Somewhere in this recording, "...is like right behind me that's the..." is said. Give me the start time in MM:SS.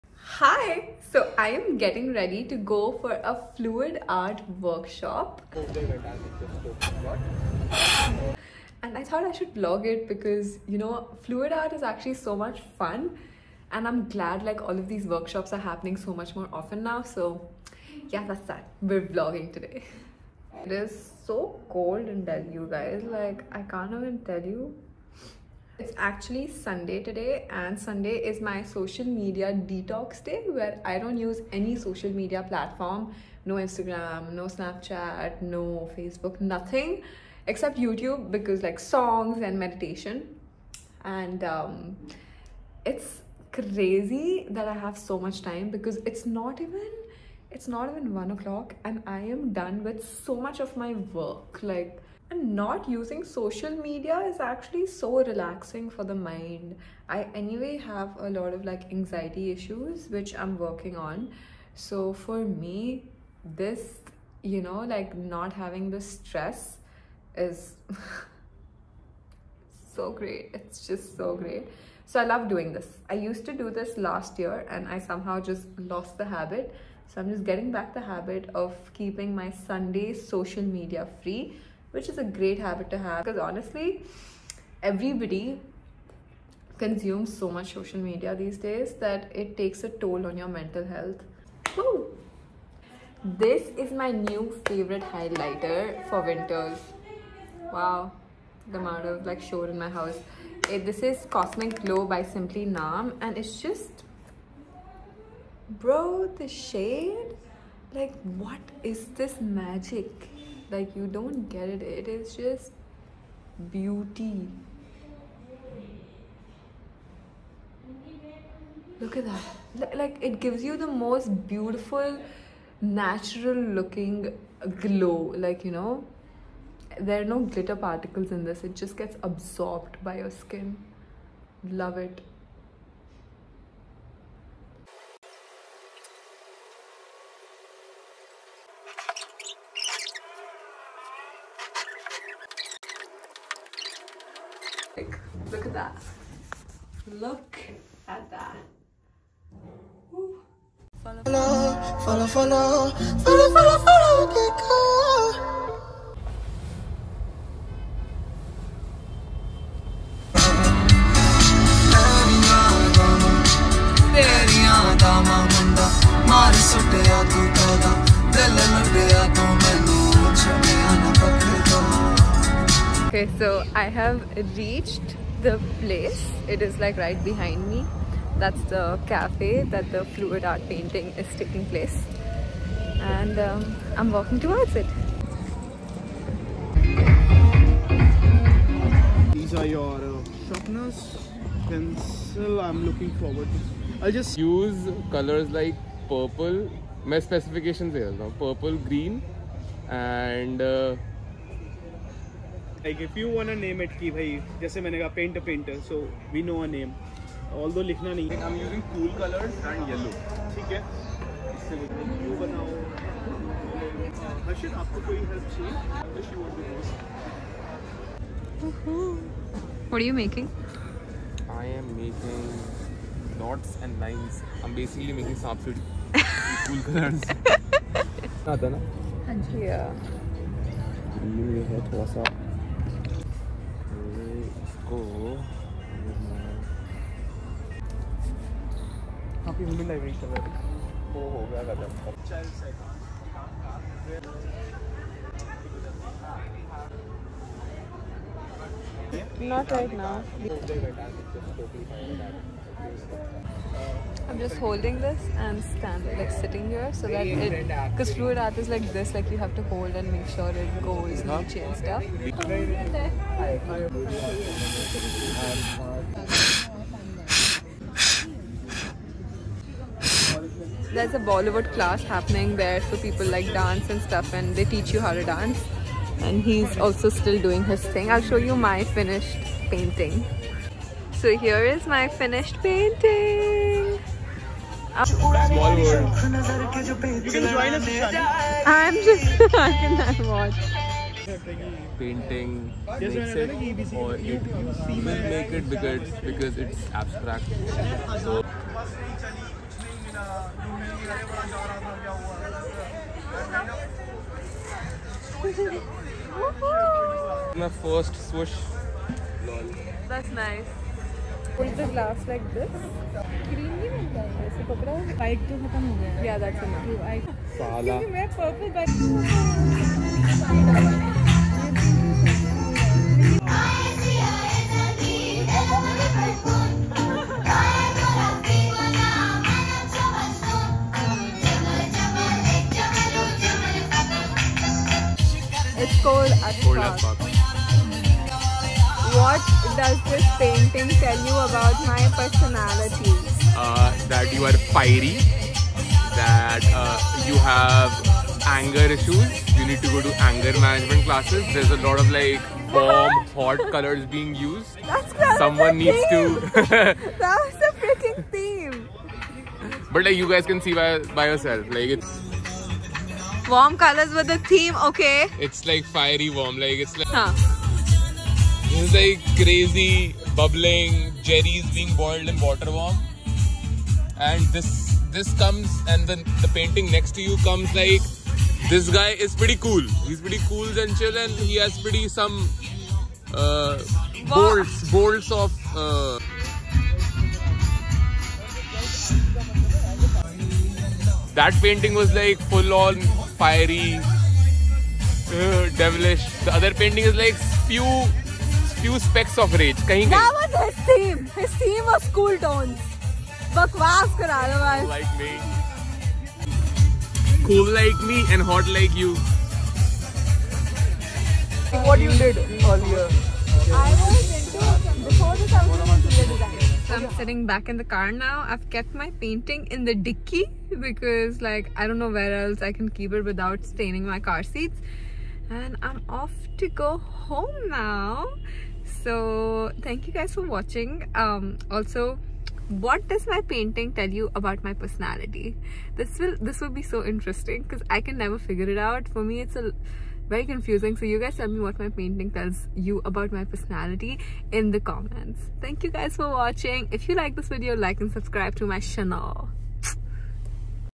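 02:56.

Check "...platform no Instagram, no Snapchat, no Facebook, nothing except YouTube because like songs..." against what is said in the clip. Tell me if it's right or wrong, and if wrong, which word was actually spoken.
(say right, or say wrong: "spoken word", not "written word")
right.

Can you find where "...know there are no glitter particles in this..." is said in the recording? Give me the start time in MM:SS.
02:05.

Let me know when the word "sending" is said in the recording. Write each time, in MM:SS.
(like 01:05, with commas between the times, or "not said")
not said.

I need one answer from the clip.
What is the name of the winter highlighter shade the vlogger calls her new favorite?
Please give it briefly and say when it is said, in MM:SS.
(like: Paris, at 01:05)
Cosmic Glow, at 01:41.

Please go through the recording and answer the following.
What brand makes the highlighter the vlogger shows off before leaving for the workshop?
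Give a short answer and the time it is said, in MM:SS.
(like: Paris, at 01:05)
Simply Nam, at 01:42.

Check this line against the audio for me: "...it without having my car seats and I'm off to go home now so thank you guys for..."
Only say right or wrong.
wrong.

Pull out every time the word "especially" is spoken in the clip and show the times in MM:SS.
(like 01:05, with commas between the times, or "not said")
not said.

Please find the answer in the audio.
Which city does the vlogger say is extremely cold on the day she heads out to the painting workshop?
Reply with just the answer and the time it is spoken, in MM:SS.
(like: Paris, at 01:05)
Delhi, at 00:22.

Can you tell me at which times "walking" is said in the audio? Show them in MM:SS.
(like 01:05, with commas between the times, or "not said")
03:04.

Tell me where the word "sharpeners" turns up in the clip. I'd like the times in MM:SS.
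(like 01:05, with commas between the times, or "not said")
03:10.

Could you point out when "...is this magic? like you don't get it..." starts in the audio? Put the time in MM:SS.
01:48.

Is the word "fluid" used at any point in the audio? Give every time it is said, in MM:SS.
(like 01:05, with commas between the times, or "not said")
00:03, 00:11, 03:00, 04:18.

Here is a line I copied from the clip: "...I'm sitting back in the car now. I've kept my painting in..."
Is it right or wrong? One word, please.
right.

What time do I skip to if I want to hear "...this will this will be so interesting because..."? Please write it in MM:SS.
07:15.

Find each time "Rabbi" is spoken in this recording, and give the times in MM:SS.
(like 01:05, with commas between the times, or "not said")
not said.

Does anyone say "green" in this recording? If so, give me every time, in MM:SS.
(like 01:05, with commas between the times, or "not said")
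03:18, 05:13.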